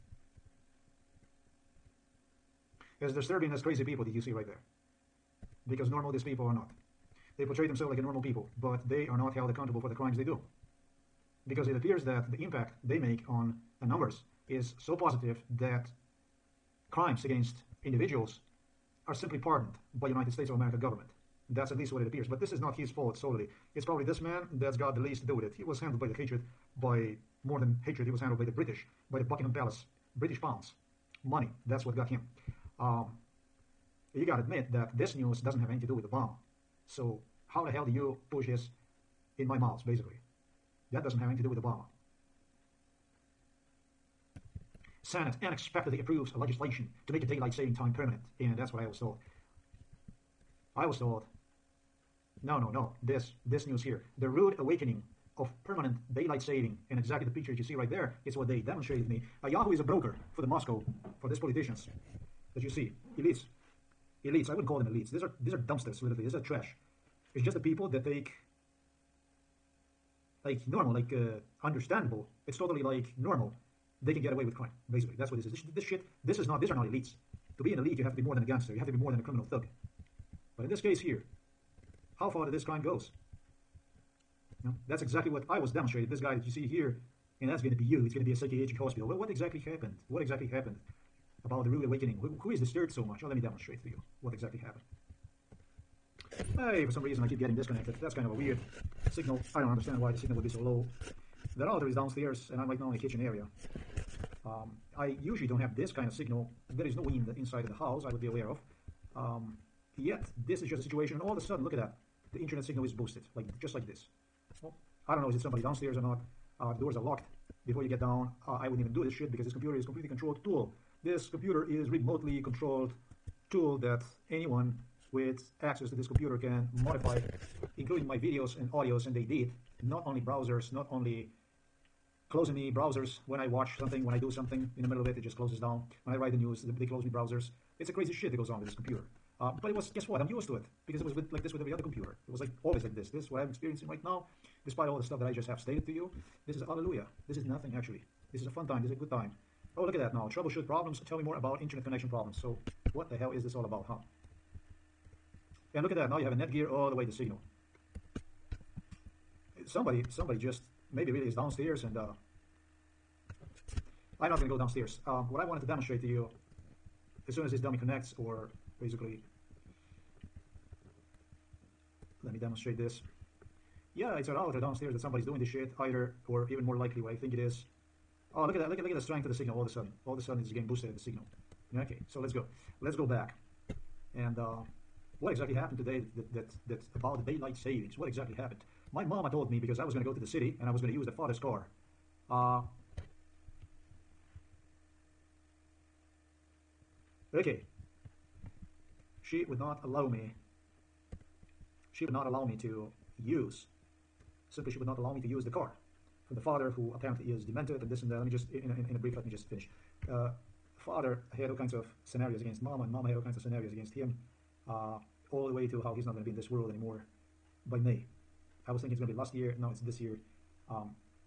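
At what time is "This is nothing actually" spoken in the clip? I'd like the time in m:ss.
2:27.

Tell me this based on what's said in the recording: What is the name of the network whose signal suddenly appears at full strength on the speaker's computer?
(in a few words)
Netgear.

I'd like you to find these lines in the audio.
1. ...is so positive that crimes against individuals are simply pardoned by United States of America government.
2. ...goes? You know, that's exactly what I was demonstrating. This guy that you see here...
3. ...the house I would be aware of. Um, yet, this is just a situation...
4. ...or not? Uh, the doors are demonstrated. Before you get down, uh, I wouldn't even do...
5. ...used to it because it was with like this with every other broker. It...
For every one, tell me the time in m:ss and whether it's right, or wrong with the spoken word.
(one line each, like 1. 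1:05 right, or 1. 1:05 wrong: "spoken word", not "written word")
1. 0:14 right
2. 1:22 right
3. 1:47 right
4. 1:55 wrong: "locked", not "demonstrated"
5. 2:20 wrong: "computer", not "broker".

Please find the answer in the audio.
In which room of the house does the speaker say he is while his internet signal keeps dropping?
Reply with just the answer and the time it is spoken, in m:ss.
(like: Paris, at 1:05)
kitchen, at 1:42.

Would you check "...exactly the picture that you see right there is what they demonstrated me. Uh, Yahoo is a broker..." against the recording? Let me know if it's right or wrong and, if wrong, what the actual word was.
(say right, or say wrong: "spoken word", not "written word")
right.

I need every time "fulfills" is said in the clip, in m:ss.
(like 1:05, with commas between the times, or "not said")
not said.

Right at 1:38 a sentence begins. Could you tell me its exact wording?
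That's kind of a weird signal.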